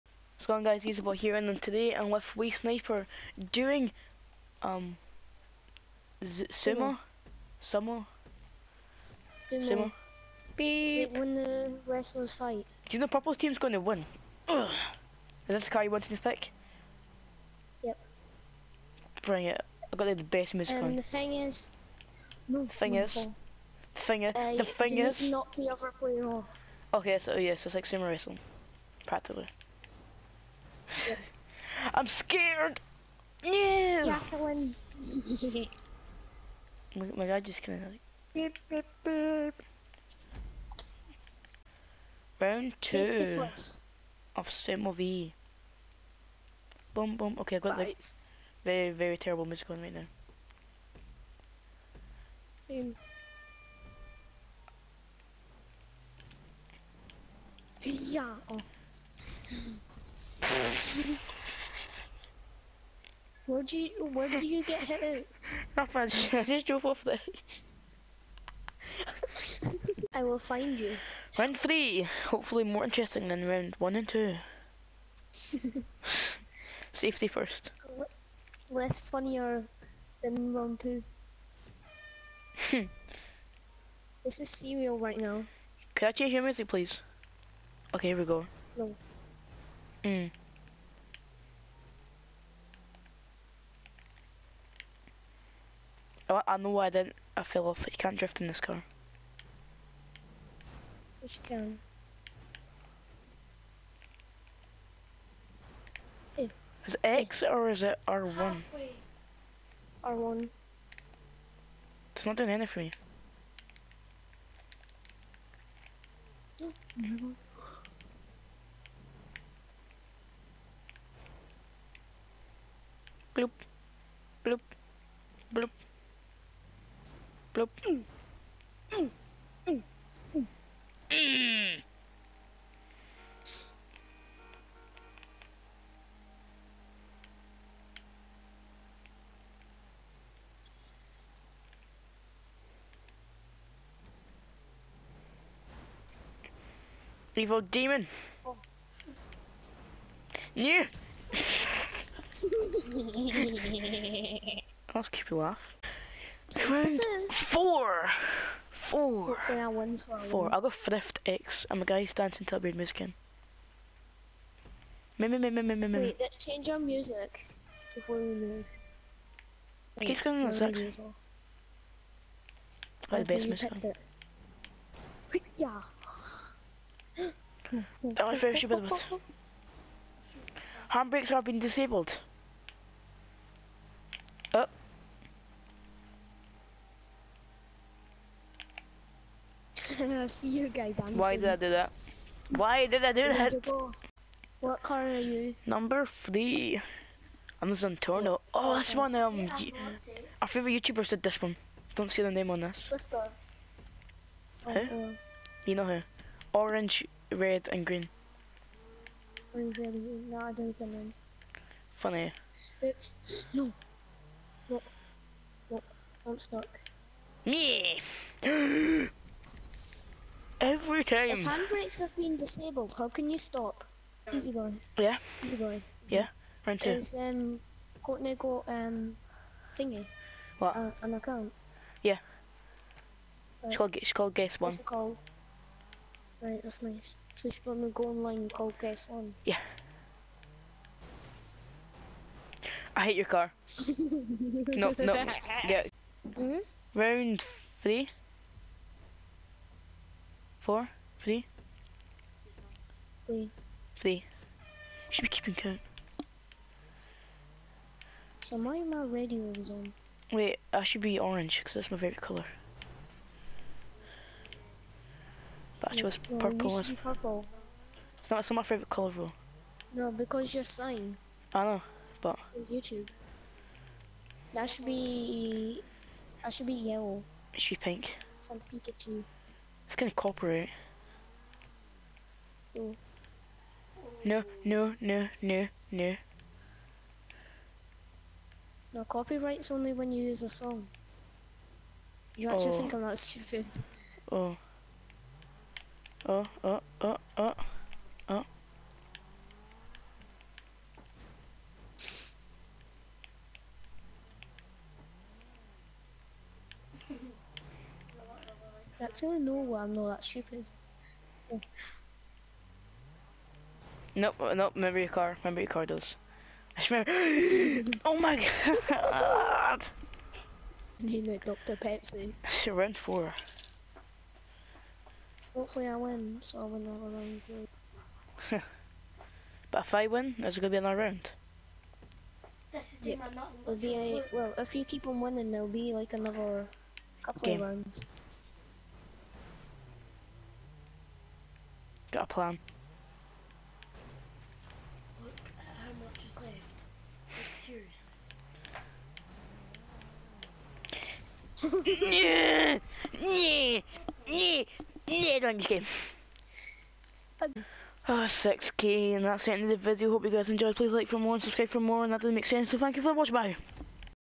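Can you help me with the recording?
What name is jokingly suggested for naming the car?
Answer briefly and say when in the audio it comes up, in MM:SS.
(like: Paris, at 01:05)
Dr. Pepsi, at 05:21.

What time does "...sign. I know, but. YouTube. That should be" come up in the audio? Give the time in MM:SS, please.
04:30.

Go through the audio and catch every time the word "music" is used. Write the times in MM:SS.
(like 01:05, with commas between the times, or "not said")
00:20, 00:49, 01:26, 02:42, 02:46, 02:53.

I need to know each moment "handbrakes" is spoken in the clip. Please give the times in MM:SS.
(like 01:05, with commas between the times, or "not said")
03:00, 03:41.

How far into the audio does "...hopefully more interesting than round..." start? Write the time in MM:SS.
01:12.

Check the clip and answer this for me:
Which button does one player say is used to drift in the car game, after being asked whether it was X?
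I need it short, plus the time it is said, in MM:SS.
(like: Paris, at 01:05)
R1, at 01:50.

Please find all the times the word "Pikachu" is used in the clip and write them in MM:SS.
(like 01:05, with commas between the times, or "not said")
04:38.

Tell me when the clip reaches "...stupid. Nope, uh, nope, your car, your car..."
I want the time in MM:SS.
05:10.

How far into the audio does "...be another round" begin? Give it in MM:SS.
05:30.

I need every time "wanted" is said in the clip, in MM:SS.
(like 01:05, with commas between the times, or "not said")
00:15.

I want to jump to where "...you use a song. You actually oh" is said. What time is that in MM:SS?
04:50.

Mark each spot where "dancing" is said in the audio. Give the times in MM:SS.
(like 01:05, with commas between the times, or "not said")
02:42, 03:10.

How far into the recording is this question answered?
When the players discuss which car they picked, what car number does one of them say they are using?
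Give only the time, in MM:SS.
03:15.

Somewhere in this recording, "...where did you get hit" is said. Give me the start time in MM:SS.
01:04.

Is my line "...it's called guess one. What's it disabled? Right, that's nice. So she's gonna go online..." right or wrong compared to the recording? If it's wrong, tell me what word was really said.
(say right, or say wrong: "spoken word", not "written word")
wrong: "called", not "disabled".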